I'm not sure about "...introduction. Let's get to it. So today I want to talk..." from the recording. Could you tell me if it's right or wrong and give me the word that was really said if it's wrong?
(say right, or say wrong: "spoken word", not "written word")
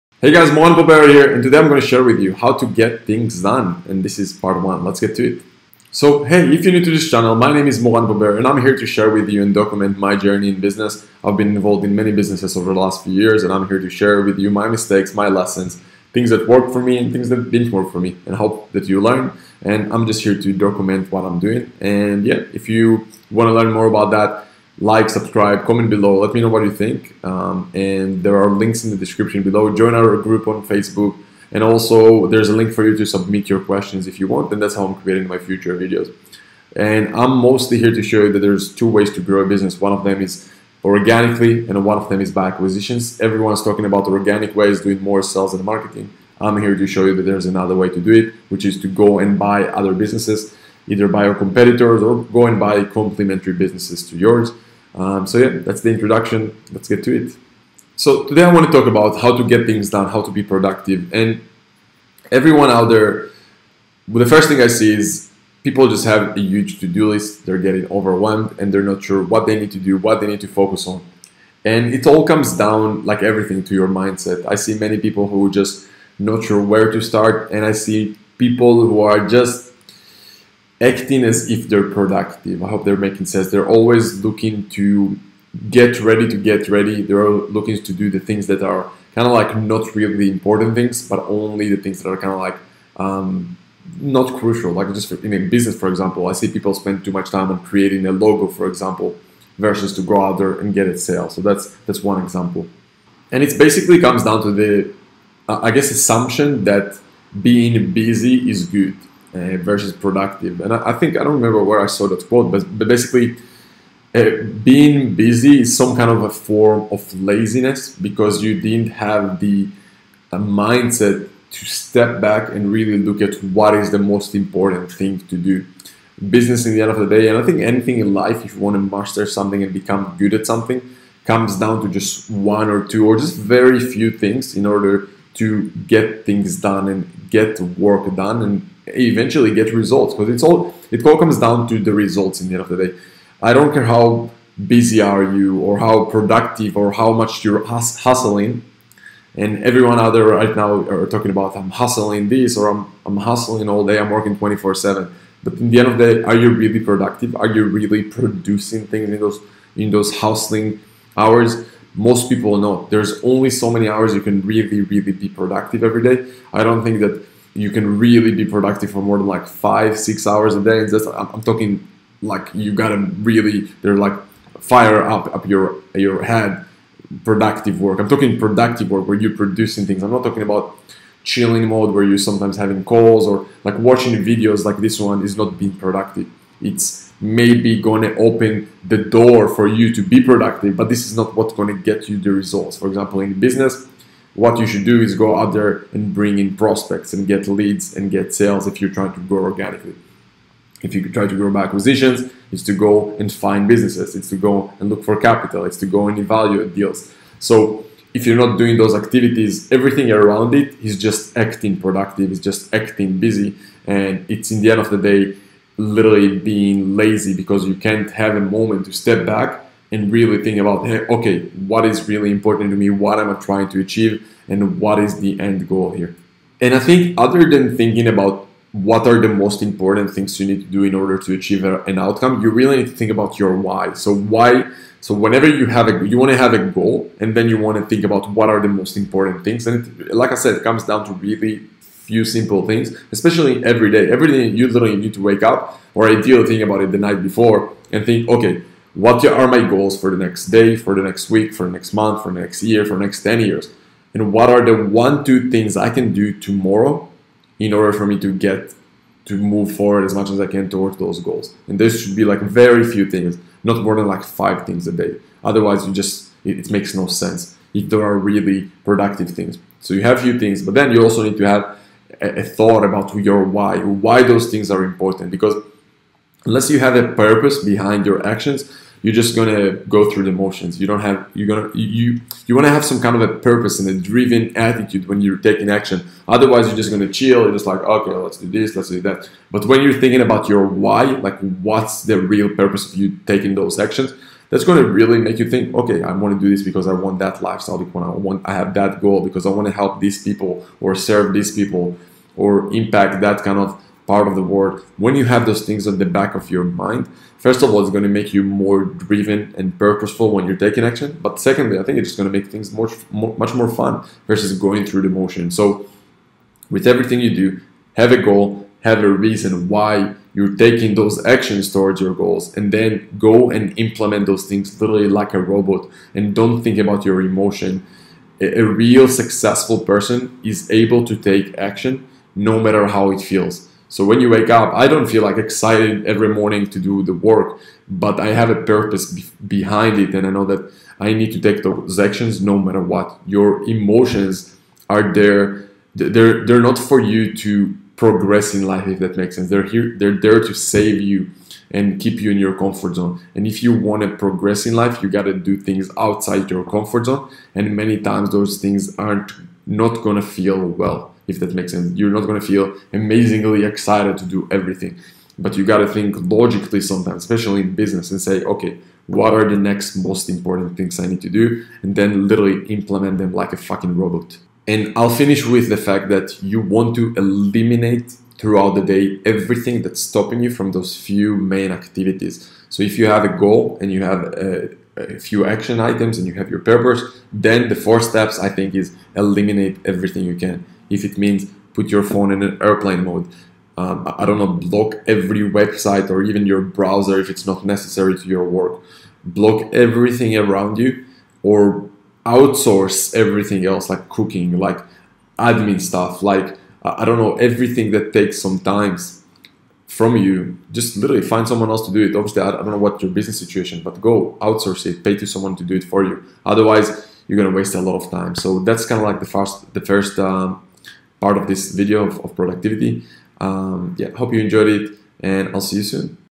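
right.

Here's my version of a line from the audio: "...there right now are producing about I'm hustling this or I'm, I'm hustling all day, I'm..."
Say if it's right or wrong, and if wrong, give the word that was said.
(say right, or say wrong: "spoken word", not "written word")
wrong: "talking", not "producing".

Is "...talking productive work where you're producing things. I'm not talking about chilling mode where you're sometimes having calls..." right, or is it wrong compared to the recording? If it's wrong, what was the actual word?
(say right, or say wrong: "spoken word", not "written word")
right.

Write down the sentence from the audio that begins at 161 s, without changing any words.
Most people know there's only so many hours you can really, really be productive every day.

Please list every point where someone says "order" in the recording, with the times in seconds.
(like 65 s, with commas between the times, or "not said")
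134 s, 230 s, 257 s.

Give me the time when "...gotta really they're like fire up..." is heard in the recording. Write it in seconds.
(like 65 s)
172 s.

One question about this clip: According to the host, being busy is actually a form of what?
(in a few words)
Laziness.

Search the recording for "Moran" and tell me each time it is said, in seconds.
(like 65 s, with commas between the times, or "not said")
0 s, 7 s.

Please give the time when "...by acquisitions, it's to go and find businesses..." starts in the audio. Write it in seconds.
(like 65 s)
201 s.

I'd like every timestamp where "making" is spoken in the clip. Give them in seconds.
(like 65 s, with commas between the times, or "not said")
82 s.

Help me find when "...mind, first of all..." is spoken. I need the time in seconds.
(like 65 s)
306 s.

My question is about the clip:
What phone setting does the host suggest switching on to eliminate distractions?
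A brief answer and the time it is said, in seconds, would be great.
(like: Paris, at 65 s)
Airplane mode, at 392 s.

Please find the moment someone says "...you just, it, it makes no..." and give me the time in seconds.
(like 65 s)
265 s.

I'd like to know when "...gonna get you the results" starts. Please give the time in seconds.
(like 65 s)
191 s.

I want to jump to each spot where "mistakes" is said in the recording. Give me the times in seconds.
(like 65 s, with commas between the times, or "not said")
14 s.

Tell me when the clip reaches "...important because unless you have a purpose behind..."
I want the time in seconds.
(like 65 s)
274 s.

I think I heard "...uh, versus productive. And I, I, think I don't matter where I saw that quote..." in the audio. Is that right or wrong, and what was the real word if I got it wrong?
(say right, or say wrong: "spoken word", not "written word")
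wrong: "remember", not "matter".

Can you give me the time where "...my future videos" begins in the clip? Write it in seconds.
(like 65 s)
35 s.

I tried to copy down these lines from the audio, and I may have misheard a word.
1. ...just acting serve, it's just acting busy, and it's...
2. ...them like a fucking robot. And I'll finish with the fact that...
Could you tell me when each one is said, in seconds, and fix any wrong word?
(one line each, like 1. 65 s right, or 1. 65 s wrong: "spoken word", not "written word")
1. 210 s wrong: "productive", not "serve"
2. 373 s right.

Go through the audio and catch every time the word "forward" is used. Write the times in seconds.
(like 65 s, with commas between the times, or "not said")
259 s.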